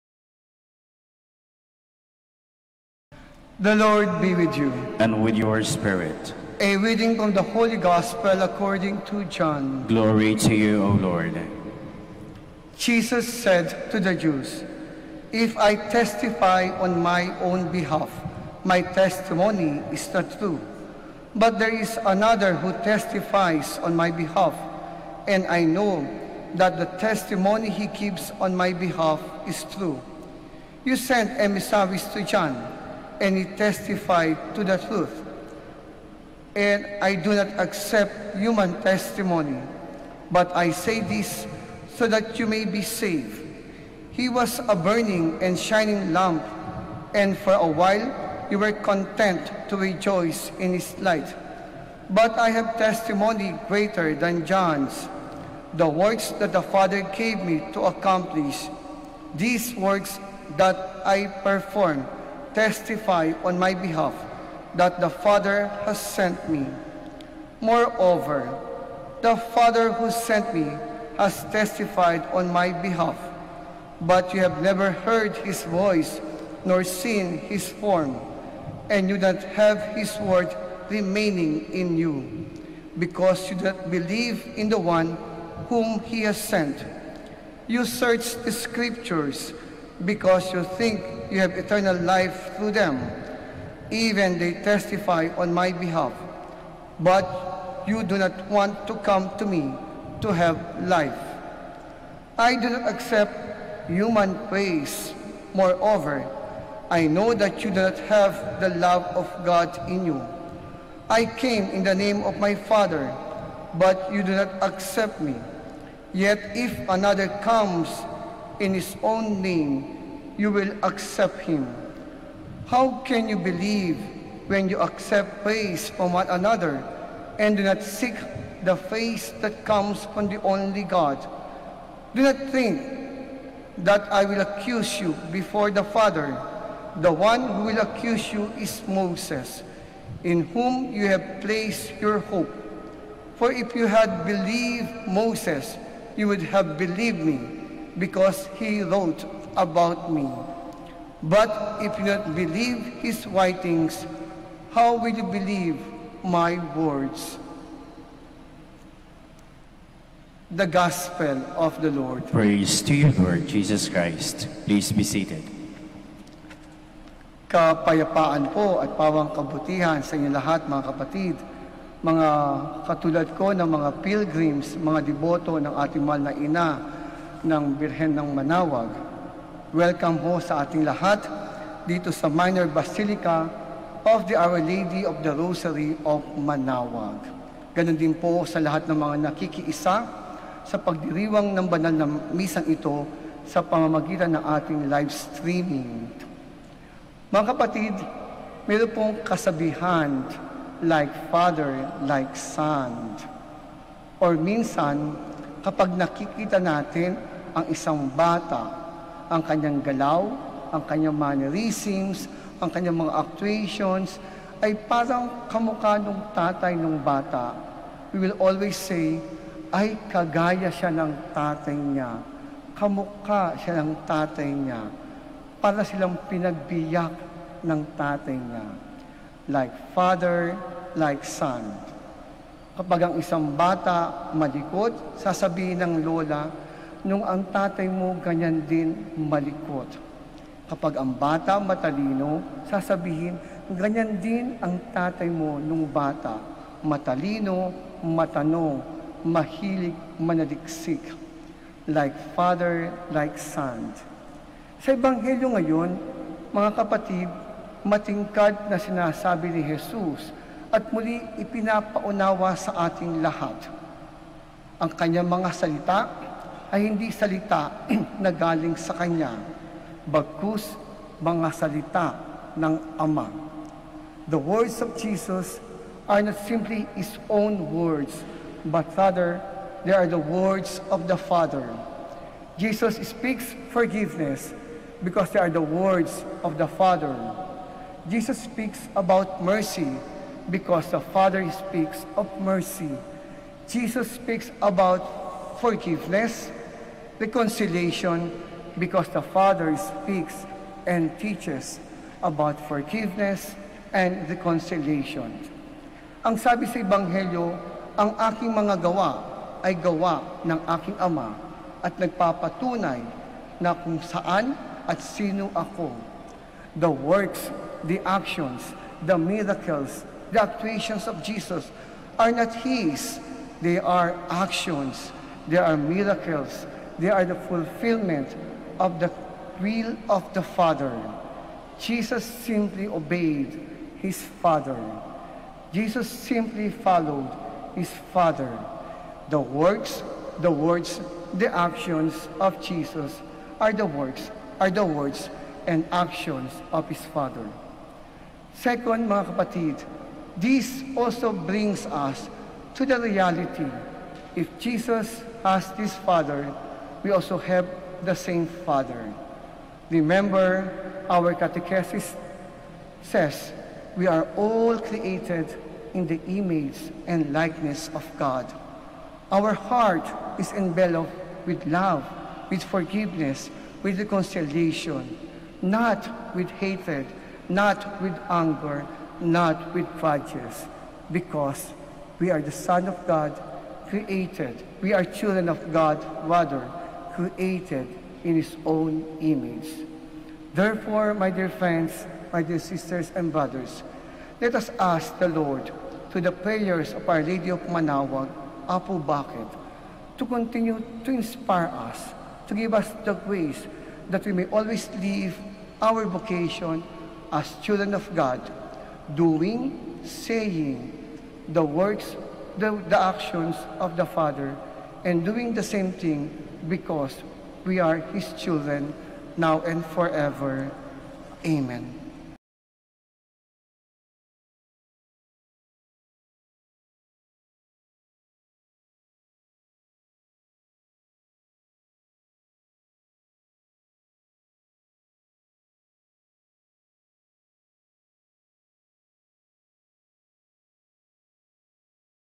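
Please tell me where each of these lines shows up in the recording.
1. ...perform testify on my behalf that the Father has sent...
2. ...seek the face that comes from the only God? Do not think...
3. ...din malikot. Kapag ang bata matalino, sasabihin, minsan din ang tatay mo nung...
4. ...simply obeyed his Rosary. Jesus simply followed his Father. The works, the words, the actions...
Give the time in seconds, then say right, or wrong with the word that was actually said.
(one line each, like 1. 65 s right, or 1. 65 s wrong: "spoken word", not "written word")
1. 61 s right
2. 127 s right
3. 238 s wrong: "ganyan", not "minsan"
4. 332 s wrong: "Father", not "Rosary".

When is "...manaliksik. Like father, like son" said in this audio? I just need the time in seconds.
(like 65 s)
250 s.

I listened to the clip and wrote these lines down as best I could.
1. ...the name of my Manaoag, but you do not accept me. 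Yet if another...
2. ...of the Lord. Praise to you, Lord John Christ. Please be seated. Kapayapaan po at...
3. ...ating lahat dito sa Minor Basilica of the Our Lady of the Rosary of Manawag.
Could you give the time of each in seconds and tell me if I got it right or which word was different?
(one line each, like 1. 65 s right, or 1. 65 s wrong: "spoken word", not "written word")
1. 111 s wrong: "Father", not "Manaoag"
2. 161 s wrong: "Jesus", not "John"
3. 180 s right.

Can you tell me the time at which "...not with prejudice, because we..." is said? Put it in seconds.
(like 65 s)
379 s.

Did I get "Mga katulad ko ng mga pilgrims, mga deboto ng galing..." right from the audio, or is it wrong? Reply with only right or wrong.
wrong.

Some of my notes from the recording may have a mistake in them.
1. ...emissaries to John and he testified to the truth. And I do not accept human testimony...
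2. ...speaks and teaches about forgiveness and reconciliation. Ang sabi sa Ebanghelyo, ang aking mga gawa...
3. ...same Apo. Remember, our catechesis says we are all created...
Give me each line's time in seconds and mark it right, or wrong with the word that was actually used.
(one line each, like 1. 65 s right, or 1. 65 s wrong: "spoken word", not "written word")
1. 31 s right
2. 299 s right
3. 358 s wrong: "Father", not "Apo".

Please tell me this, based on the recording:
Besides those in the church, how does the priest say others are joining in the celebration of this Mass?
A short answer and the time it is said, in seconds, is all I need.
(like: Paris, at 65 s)
Live streaming, at 194 s.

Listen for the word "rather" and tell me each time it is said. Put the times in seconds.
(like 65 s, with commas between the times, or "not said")
278 s, 386 s.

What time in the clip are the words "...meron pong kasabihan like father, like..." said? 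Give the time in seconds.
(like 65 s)
198 s.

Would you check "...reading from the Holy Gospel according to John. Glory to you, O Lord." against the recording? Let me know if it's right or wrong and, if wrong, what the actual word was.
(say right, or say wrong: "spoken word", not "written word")
right.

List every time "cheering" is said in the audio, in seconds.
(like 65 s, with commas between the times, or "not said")
not said.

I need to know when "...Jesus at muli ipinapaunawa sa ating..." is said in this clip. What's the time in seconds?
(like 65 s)
259 s.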